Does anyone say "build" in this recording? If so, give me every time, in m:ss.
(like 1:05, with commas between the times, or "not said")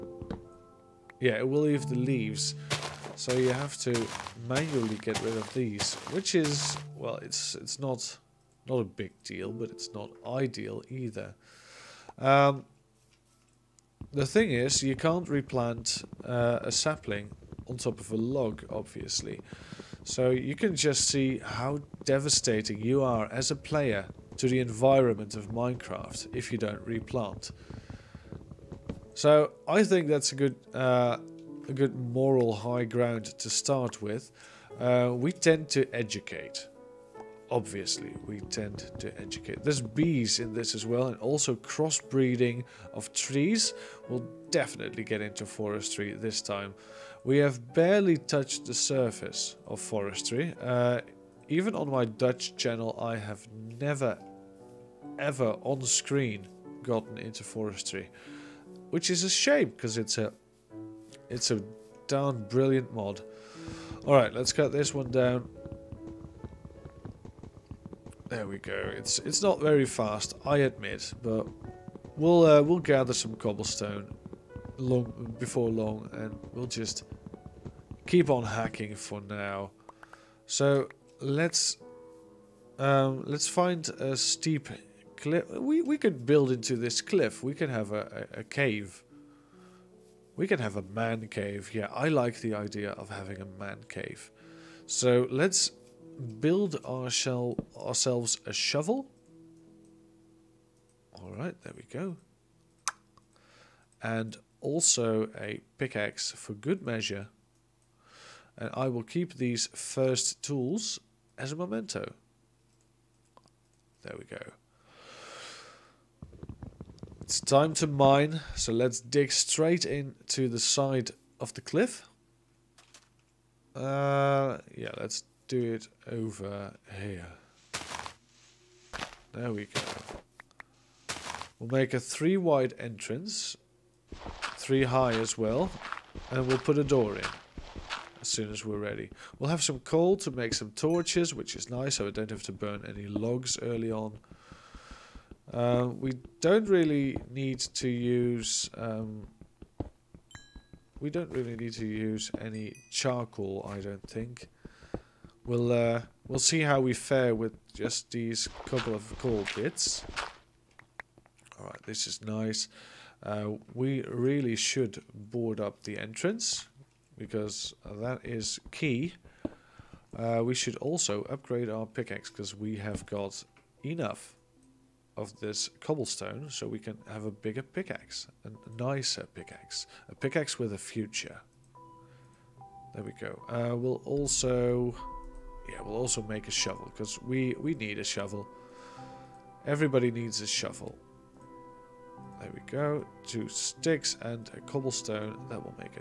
1:26, 1:36.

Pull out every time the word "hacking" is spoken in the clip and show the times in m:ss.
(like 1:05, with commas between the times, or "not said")
1:18.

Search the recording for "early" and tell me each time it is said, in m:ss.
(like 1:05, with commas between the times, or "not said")
2:23.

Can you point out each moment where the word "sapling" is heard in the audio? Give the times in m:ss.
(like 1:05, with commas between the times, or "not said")
0:16.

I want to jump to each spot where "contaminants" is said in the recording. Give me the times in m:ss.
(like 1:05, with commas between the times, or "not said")
not said.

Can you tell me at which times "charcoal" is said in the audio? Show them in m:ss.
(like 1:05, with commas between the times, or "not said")
2:32.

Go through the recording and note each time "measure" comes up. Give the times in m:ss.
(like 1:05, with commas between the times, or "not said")
1:46.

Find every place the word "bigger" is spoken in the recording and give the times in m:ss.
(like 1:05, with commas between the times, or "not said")
2:57.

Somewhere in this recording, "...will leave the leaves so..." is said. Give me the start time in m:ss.
0:01.